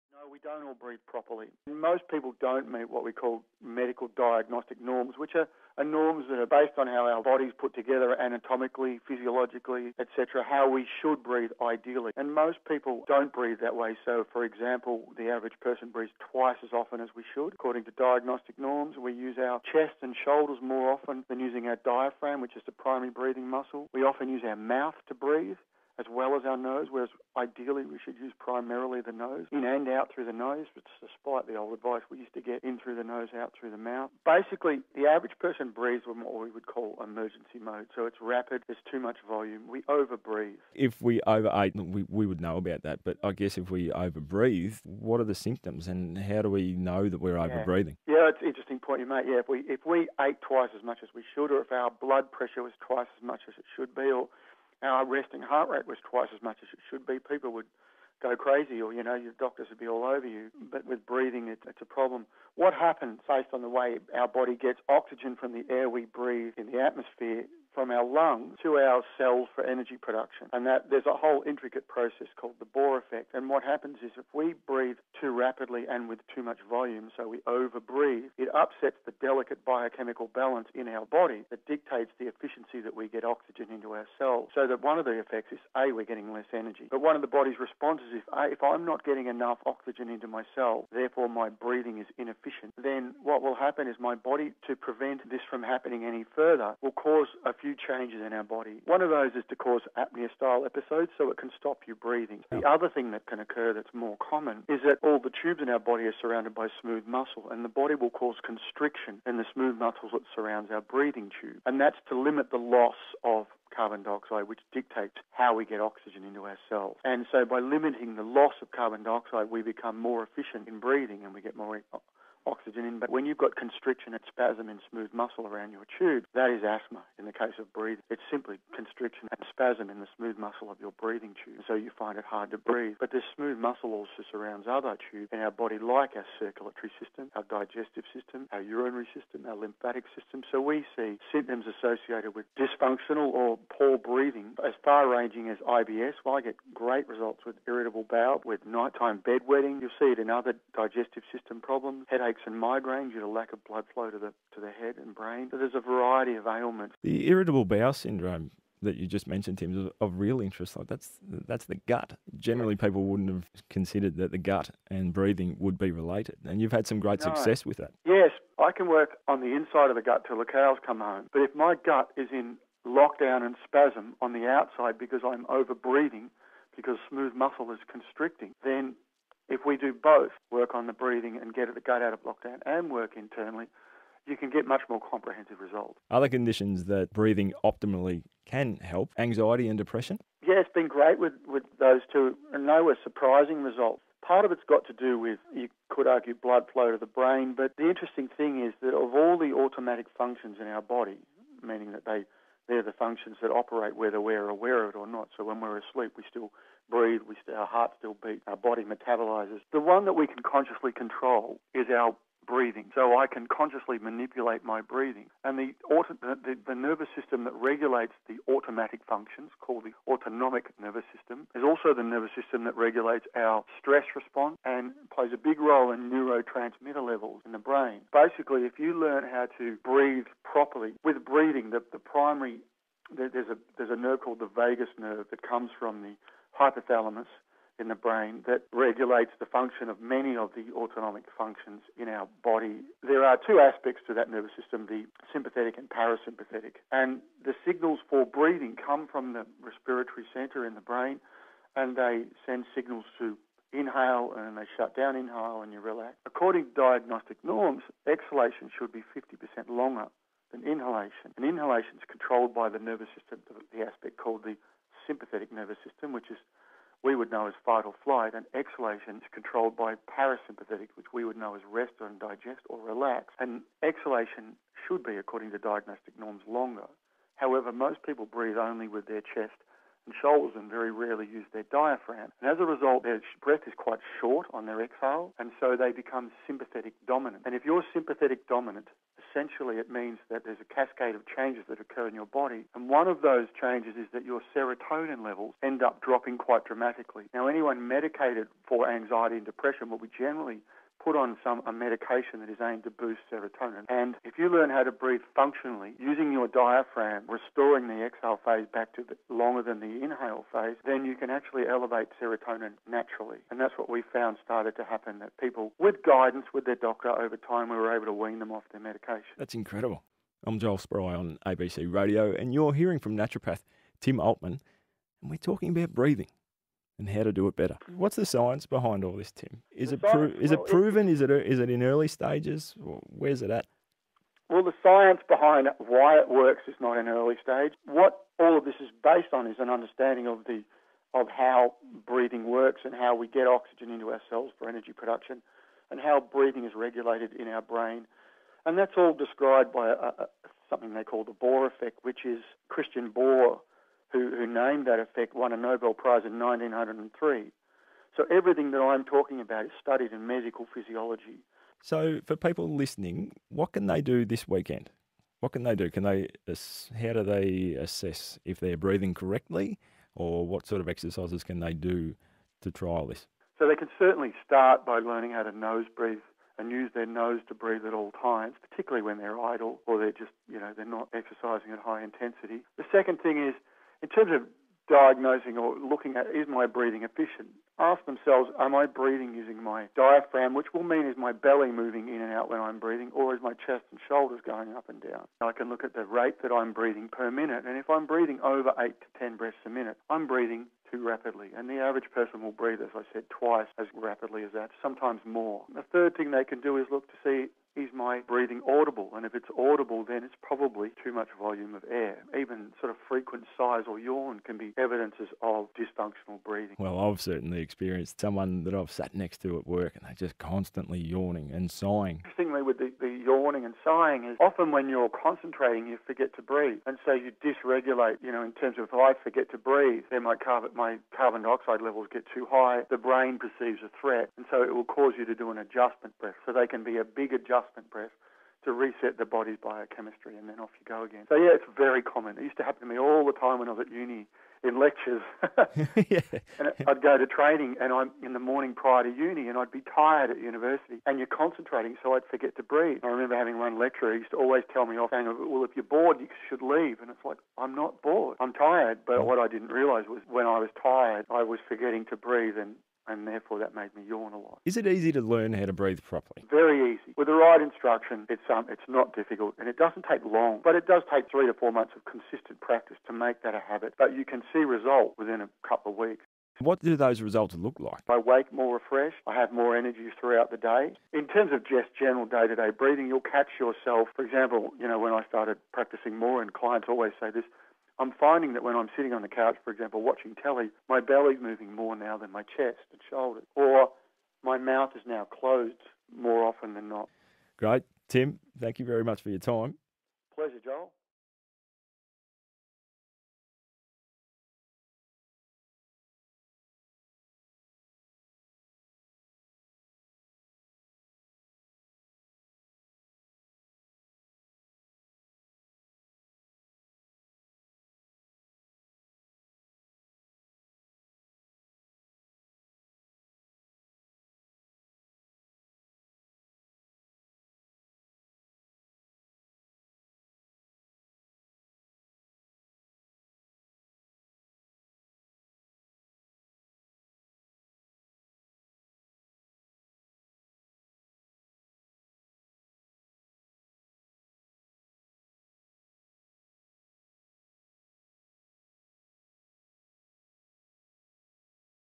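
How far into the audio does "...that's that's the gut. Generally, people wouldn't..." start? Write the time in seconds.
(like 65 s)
160 s.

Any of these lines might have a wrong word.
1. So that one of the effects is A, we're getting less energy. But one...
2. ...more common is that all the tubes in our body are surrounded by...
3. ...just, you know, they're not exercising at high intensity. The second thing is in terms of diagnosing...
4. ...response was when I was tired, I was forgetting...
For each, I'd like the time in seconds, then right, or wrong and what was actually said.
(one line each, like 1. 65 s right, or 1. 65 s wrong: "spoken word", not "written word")
1. 84 s right
2. 103 s right
3. 380 s right
4. 459 s wrong: "realise", not "response".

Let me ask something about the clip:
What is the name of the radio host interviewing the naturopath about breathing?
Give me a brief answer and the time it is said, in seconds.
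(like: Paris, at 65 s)
Joel Spry, at 320 s.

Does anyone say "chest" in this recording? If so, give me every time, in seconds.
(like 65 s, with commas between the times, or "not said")
19 s, 279 s, 393 s, 492 s.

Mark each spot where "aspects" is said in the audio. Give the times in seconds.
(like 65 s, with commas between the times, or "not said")
243 s, 263 s.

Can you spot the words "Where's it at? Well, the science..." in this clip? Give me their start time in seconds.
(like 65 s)
332 s.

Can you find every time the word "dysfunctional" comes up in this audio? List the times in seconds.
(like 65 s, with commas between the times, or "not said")
142 s, 415 s.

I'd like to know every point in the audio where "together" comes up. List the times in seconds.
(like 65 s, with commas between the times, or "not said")
7 s.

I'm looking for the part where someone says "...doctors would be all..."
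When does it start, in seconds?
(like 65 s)
59 s.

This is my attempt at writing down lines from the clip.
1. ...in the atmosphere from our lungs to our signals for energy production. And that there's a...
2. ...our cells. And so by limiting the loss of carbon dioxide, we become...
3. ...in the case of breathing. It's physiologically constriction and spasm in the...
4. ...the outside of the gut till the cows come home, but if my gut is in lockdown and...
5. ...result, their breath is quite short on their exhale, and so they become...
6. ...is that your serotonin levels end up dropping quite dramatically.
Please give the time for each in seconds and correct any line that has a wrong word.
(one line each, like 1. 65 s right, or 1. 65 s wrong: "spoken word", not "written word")
1. 66 s wrong: "cells", not "signals"
2. 116 s right
3. 127 s wrong: "simply", not "physiologically"
4. 169 s wrong: "inside", not "outside"
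5. 282 s right
6. 293 s right.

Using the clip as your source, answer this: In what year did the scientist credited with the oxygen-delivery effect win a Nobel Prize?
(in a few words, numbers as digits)
1903.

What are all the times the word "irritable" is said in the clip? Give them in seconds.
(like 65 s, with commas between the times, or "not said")
147 s, 157 s.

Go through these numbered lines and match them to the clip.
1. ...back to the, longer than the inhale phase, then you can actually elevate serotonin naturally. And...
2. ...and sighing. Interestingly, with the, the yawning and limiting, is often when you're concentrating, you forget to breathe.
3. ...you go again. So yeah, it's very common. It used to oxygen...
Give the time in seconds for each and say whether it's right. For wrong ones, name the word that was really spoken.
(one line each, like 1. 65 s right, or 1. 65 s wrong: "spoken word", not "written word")
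1. 308 s right
2. 421 s wrong: "sighing", not "limiting"
3. 440 s wrong: "happen", not "oxygen".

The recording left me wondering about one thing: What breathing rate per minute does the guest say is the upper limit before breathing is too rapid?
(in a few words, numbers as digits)
8 to 10.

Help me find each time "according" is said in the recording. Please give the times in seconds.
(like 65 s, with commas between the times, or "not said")
17 s, 256 s, 275 s.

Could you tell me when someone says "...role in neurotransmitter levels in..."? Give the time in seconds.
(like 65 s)
225 s.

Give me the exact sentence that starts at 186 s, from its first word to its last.
Other conditions that breathing optimally can help anxiety and depression?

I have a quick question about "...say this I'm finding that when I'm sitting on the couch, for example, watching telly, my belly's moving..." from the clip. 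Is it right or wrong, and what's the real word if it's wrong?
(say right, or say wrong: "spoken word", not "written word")
right.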